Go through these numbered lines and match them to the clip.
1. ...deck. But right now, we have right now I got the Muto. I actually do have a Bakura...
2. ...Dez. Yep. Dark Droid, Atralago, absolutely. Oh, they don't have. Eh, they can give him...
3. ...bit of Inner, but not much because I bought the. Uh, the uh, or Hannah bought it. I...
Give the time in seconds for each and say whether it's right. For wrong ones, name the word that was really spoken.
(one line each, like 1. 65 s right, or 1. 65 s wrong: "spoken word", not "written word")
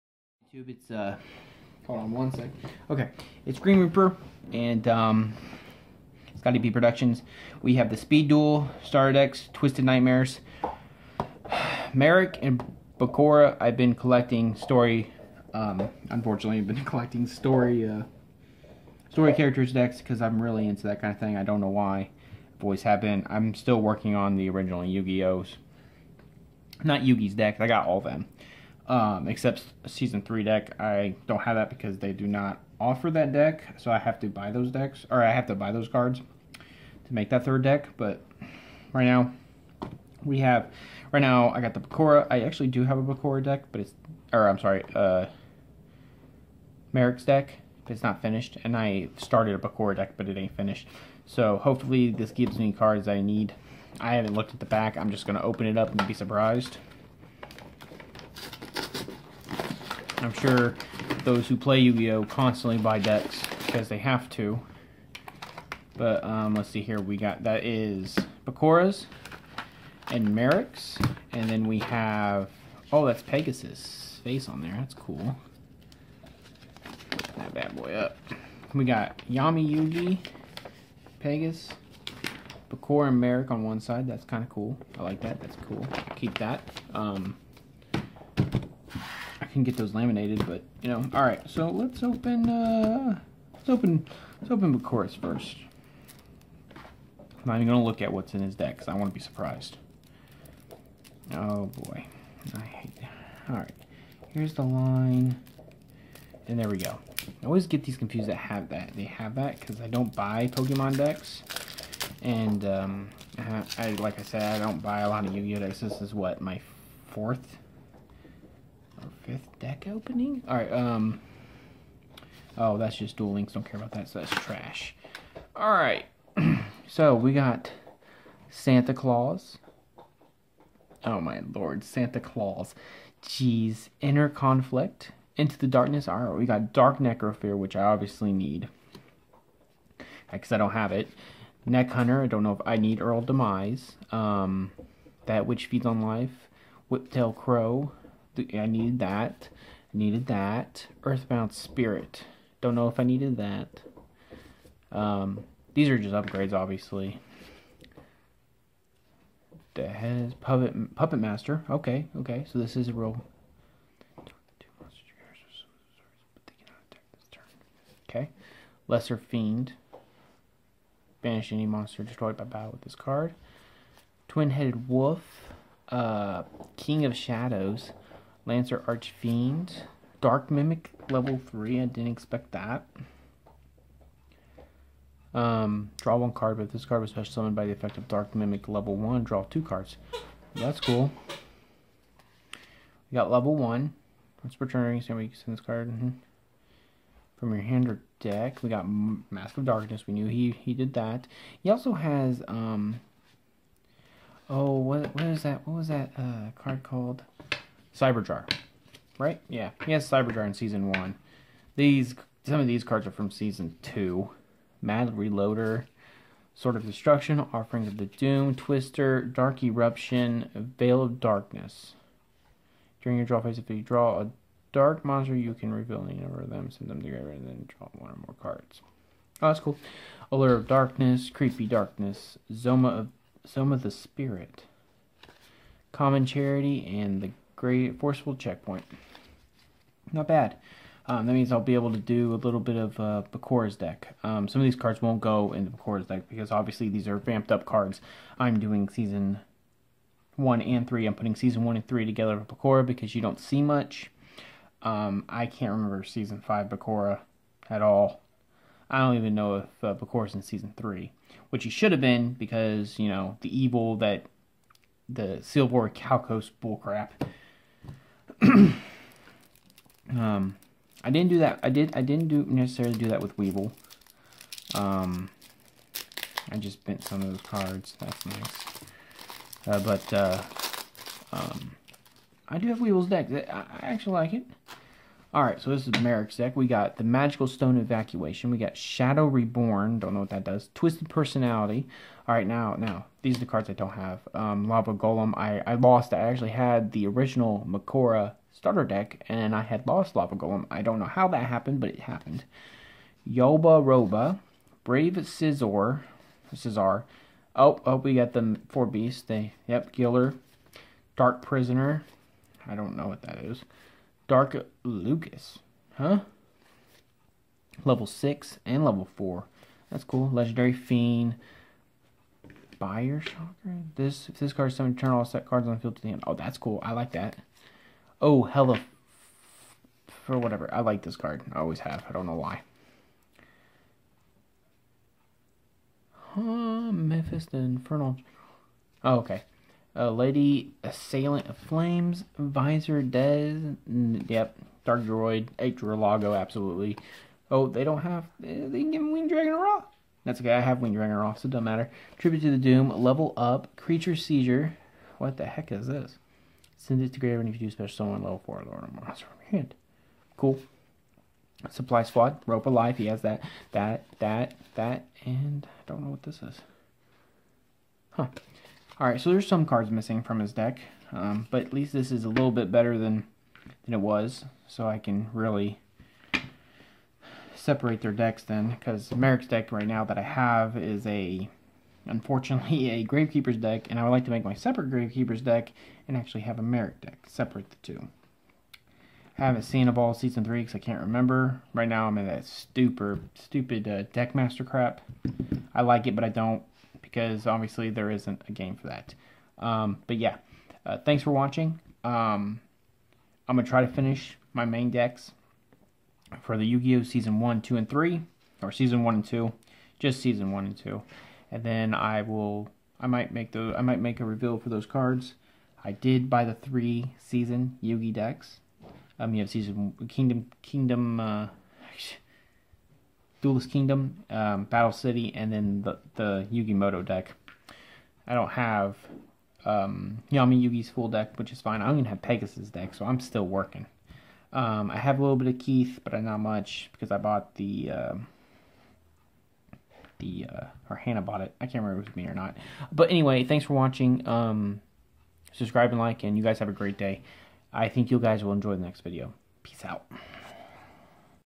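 1. 37 s wrong: "Bakura", not "Muto"
2. 343 s right
3. 435 s wrong: "Keith", not "Inner".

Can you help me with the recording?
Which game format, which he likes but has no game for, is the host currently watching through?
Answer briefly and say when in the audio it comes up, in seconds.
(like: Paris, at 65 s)
Deckmaster, at 394 s.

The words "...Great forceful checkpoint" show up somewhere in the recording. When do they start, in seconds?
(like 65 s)
237 s.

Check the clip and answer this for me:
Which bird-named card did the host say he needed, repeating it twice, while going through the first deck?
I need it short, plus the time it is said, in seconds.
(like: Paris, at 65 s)
Whiptail Crow, at 146 s.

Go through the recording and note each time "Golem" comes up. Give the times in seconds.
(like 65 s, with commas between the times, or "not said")
294 s, 300 s.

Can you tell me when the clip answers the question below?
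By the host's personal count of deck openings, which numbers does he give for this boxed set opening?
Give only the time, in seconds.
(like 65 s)
117 s.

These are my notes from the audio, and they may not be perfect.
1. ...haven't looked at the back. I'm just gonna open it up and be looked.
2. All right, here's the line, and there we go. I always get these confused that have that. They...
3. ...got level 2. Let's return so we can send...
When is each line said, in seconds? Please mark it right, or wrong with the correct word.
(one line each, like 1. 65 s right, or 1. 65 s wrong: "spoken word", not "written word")
1. 54 s wrong: "surprised", not "looked"
2. 103 s right
3. 193 s wrong: "1", not "2".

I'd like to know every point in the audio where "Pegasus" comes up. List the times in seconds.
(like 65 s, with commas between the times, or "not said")
73 s, 81 s, 432 s.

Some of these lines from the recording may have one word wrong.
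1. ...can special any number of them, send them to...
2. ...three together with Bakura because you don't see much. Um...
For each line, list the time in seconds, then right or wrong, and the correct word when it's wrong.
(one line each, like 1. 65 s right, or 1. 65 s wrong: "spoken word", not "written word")
1. 225 s wrong: "reveal", not "special"
2. 251 s right.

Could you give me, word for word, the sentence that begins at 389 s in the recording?
I haven't seen a ball season three because I can't remember.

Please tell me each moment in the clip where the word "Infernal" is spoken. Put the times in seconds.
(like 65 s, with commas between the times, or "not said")
337 s.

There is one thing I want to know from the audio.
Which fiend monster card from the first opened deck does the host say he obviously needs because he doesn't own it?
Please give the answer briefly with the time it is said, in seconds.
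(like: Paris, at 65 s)
Dark Necrofear, at 136 s.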